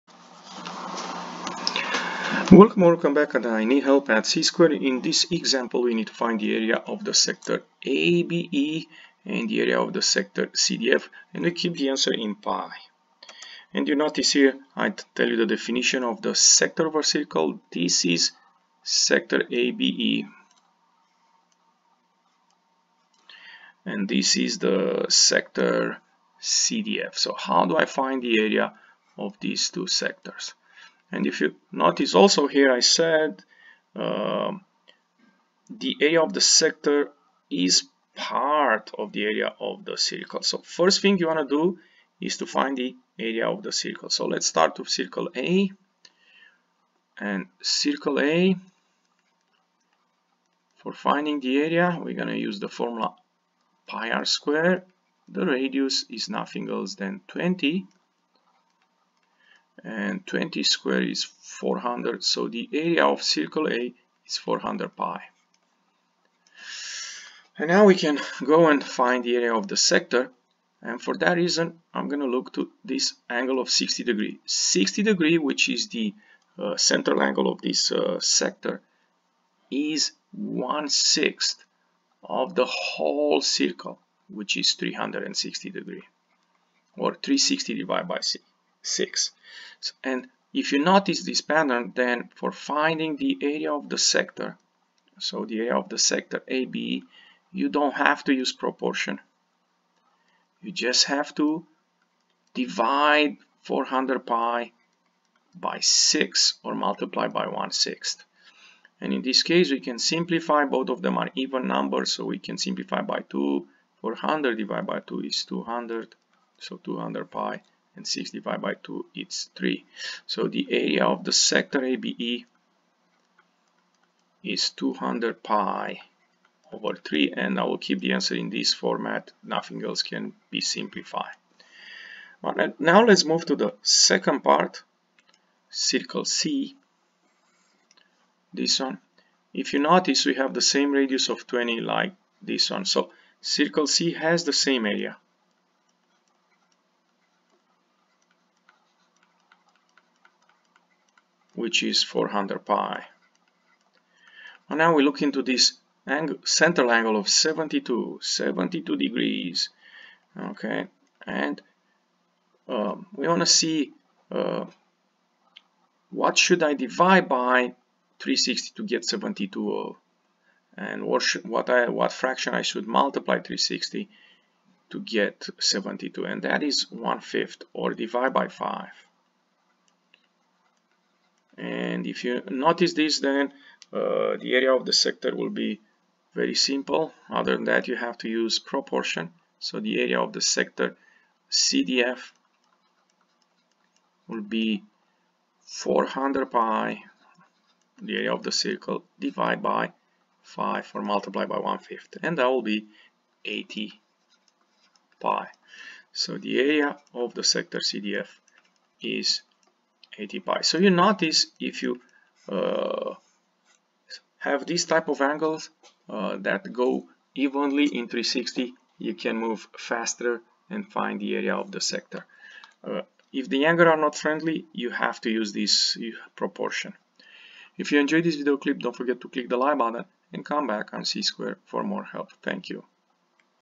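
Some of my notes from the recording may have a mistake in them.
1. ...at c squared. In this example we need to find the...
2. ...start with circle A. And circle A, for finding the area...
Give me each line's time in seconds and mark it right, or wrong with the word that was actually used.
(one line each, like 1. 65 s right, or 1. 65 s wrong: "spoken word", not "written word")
1. 4 s right
2. 44 s right.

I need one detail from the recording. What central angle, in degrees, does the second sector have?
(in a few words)
72.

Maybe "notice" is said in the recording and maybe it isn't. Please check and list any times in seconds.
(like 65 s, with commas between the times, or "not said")
13 s, 31 s, 90 s, 139 s, 182 s, 210 s.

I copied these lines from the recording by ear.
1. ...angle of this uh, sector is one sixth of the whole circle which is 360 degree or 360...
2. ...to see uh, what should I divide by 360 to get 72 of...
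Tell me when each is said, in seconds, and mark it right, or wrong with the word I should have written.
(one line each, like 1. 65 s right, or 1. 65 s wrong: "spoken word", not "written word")
1. 77 s right
2. 163 s right.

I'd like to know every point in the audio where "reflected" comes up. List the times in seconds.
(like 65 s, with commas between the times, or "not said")
not said.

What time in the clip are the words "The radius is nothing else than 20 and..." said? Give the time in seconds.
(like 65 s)
55 s.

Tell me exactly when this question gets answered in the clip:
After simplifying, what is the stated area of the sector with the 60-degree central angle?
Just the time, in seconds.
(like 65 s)
124 s.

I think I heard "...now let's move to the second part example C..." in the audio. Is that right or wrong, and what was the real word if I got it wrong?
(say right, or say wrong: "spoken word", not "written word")
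wrong: "circle", not "example".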